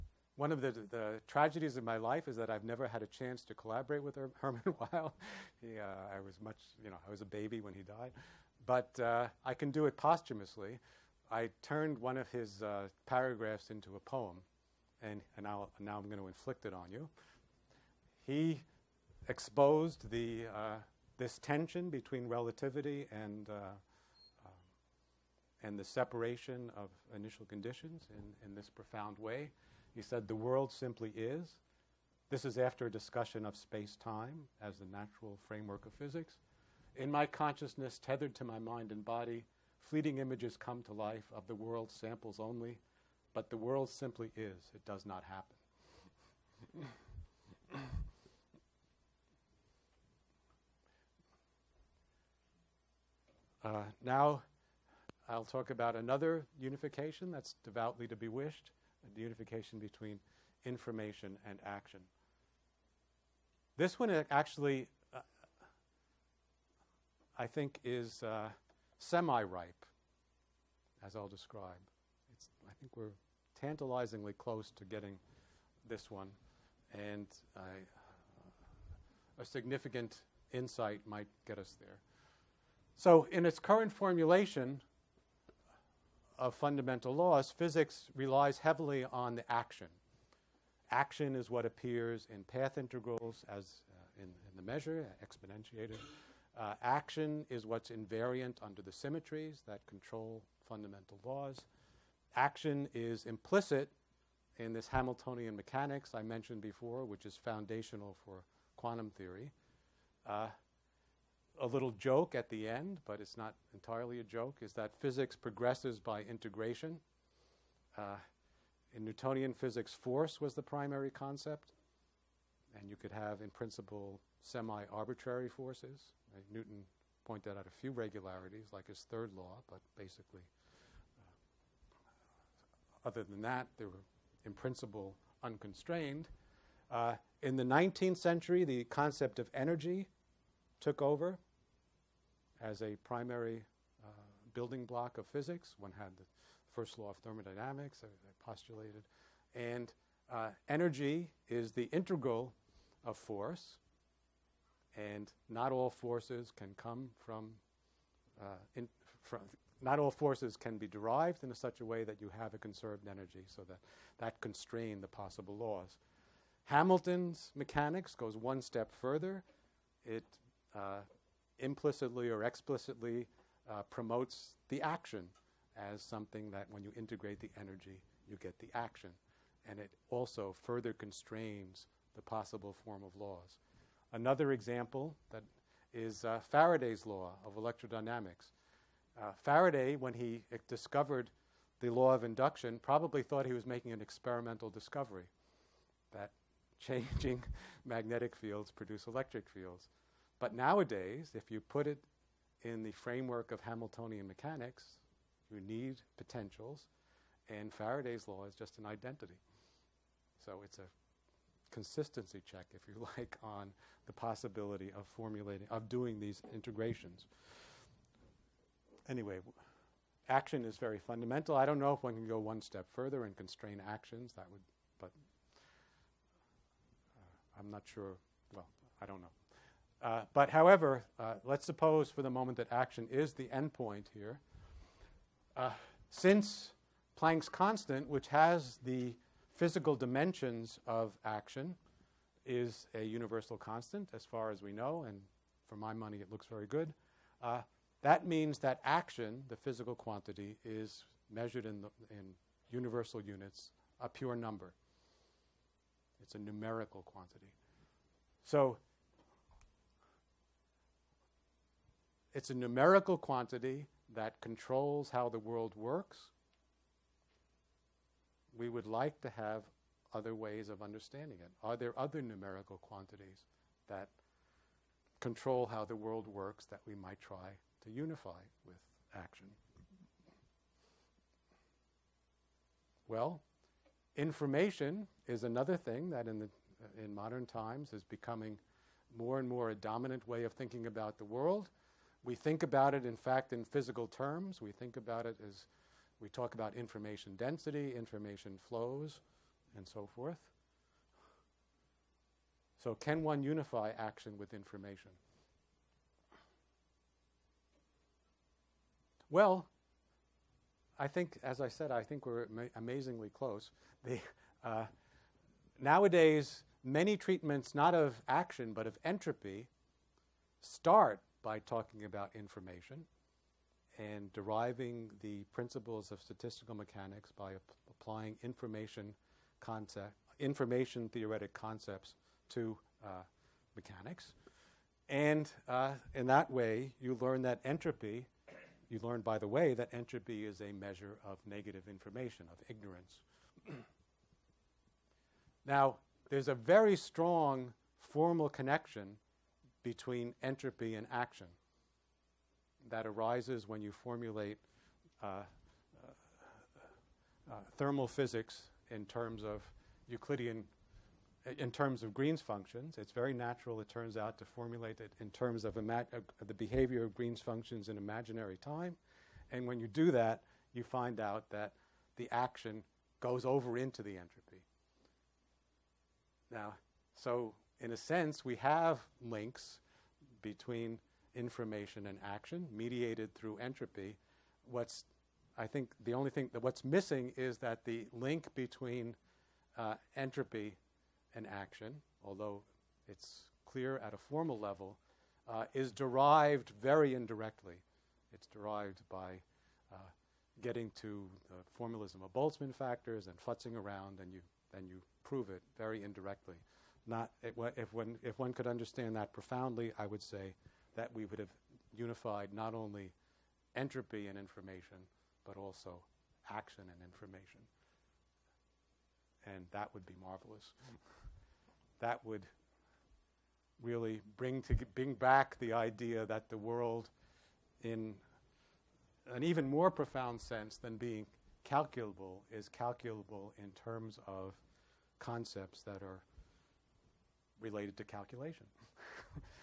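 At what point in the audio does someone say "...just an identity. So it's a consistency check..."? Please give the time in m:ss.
3:28.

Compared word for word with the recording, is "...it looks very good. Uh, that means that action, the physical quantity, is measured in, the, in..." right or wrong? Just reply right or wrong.
right.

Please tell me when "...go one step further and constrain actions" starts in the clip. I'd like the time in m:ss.
3:42.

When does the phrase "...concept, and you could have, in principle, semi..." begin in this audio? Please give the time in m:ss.
2:01.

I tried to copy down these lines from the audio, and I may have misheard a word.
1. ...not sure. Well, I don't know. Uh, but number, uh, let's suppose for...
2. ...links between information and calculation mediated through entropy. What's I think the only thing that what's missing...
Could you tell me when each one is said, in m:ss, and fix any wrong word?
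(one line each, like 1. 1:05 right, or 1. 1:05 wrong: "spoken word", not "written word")
1. 3:47 wrong: "however", not "number"
2. 6:19 wrong: "action", not "calculation".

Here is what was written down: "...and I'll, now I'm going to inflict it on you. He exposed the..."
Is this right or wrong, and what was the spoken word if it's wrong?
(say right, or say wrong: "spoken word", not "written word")
right.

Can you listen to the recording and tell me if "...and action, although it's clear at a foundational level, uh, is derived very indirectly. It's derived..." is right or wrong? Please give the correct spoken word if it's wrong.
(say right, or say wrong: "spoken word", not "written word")
wrong: "formal", not "foundational".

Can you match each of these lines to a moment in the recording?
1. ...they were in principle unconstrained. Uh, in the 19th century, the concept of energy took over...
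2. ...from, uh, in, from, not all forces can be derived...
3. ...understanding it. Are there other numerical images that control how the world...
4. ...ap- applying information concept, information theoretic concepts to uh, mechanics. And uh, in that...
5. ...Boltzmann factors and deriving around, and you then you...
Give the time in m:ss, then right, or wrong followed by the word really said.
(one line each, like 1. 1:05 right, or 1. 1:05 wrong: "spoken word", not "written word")
1. 2:13 right
2. 2:37 right
3. 4:30 wrong: "quantities", not "images"
4. 5:27 right
5. 6:42 wrong: "futzing", not "deriving".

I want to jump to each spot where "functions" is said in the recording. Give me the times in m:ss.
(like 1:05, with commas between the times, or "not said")
6:02, 6:07.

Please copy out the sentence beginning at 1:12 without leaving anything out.
It's, I think we're tantalizingly close to getting this one, and I, uh, a significant insight might get us there.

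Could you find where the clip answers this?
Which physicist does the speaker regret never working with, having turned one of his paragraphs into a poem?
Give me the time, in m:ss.
0:04.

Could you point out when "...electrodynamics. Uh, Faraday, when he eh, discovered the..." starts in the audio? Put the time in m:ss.
3:07.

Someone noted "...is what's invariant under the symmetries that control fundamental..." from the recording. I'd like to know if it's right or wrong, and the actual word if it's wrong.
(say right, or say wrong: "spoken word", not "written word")
right.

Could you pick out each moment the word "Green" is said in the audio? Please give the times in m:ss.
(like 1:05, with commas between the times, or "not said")
6:02, 6:07.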